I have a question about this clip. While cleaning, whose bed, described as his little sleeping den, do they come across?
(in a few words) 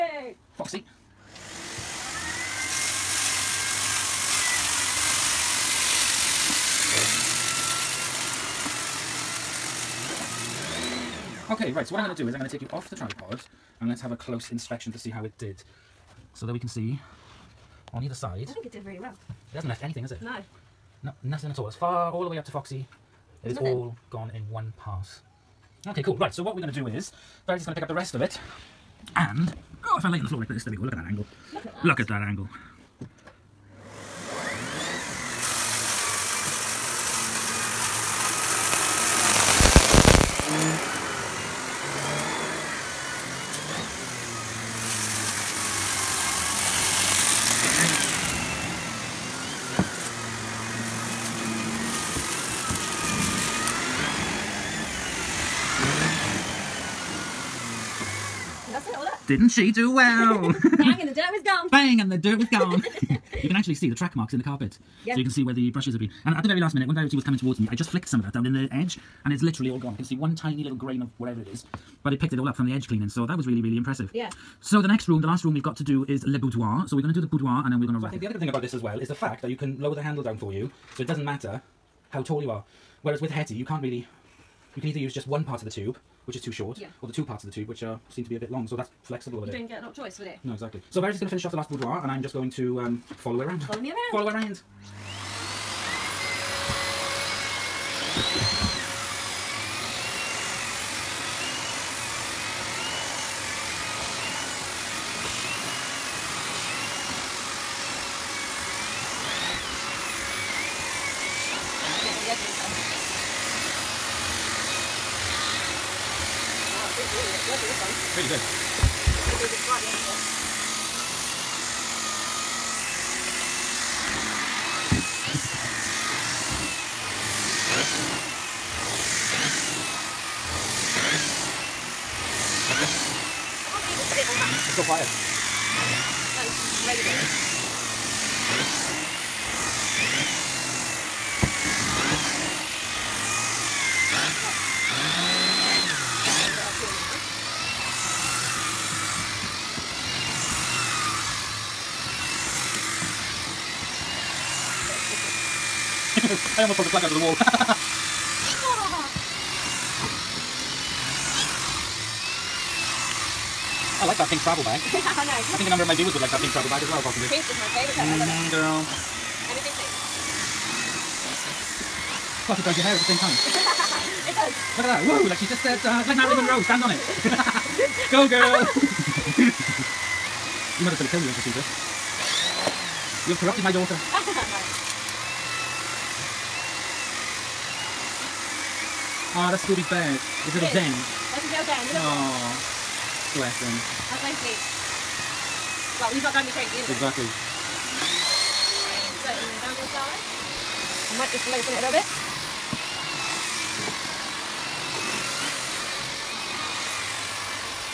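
Scooby.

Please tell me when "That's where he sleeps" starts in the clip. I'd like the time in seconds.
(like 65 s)
194 s.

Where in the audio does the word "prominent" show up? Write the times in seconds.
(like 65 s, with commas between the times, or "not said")
not said.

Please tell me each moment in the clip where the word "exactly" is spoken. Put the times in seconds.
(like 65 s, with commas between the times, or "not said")
90 s, 196 s.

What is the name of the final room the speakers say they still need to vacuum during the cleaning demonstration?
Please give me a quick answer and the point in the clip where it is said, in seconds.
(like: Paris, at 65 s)
Le Boudoir, at 76 s.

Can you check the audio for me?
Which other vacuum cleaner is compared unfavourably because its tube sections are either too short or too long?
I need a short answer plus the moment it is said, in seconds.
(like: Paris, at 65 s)
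Hetty, at 83 s.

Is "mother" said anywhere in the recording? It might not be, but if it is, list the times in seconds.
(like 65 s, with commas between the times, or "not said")
180 s.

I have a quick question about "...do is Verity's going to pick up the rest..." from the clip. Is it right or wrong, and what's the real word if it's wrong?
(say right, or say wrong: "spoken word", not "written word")
right.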